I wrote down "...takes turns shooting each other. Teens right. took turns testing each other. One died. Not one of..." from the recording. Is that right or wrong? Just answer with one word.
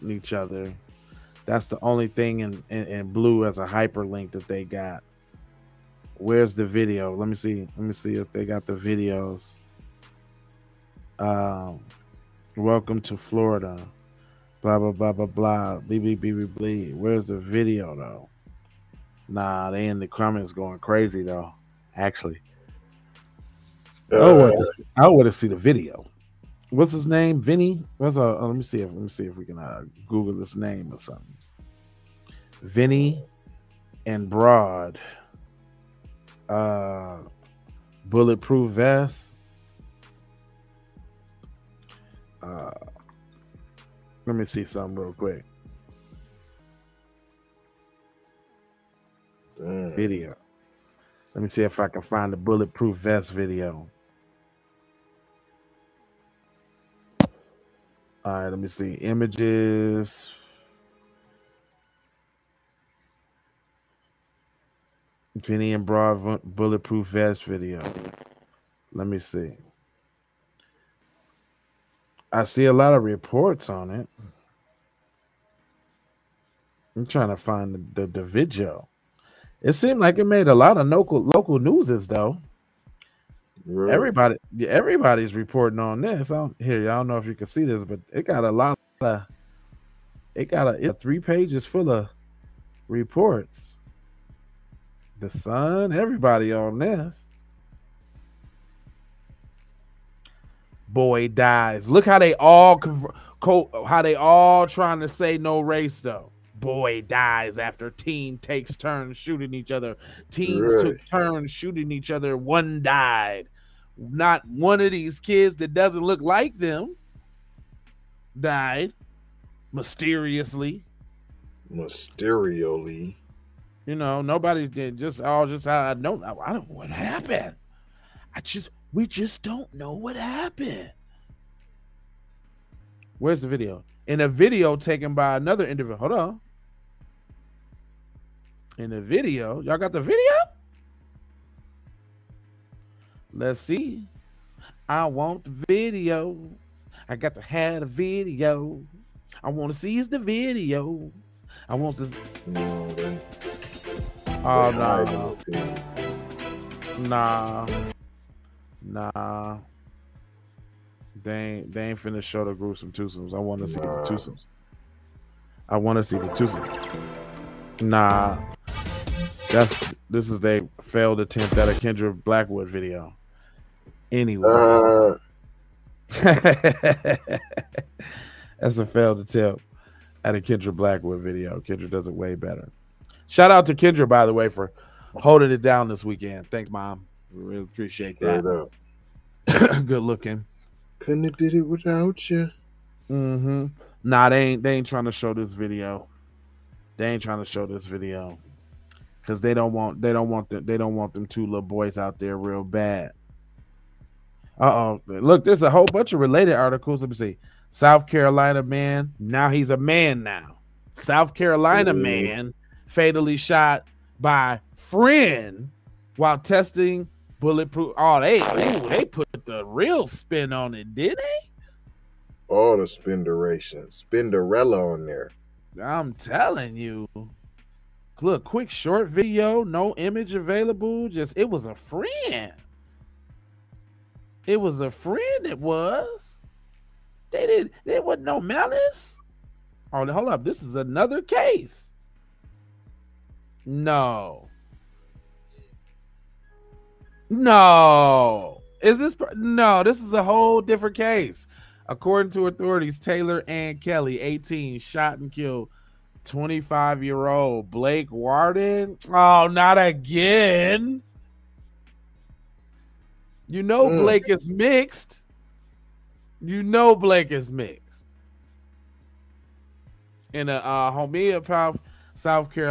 wrong.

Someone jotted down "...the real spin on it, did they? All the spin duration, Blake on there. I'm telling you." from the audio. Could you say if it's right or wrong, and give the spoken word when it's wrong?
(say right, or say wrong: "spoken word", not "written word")
wrong: "Spinderella", not "Blake".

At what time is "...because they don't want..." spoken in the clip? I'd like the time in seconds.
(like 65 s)
199 s.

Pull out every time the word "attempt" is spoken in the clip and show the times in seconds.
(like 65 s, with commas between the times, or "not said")
171 s, 179 s.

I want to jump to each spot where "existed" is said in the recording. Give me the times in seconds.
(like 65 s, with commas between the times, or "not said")
not said.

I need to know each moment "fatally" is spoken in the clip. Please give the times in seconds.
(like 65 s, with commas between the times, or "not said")
212 s.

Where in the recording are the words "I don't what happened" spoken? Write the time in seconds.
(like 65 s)
126 s.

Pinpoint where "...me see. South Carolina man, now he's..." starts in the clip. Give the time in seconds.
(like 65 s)
207 s.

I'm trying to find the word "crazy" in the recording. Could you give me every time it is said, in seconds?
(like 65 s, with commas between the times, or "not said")
20 s.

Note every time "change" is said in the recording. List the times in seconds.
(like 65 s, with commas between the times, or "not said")
not said.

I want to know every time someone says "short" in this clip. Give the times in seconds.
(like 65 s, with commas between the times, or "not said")
228 s.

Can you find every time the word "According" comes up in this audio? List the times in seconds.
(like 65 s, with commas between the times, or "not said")
251 s.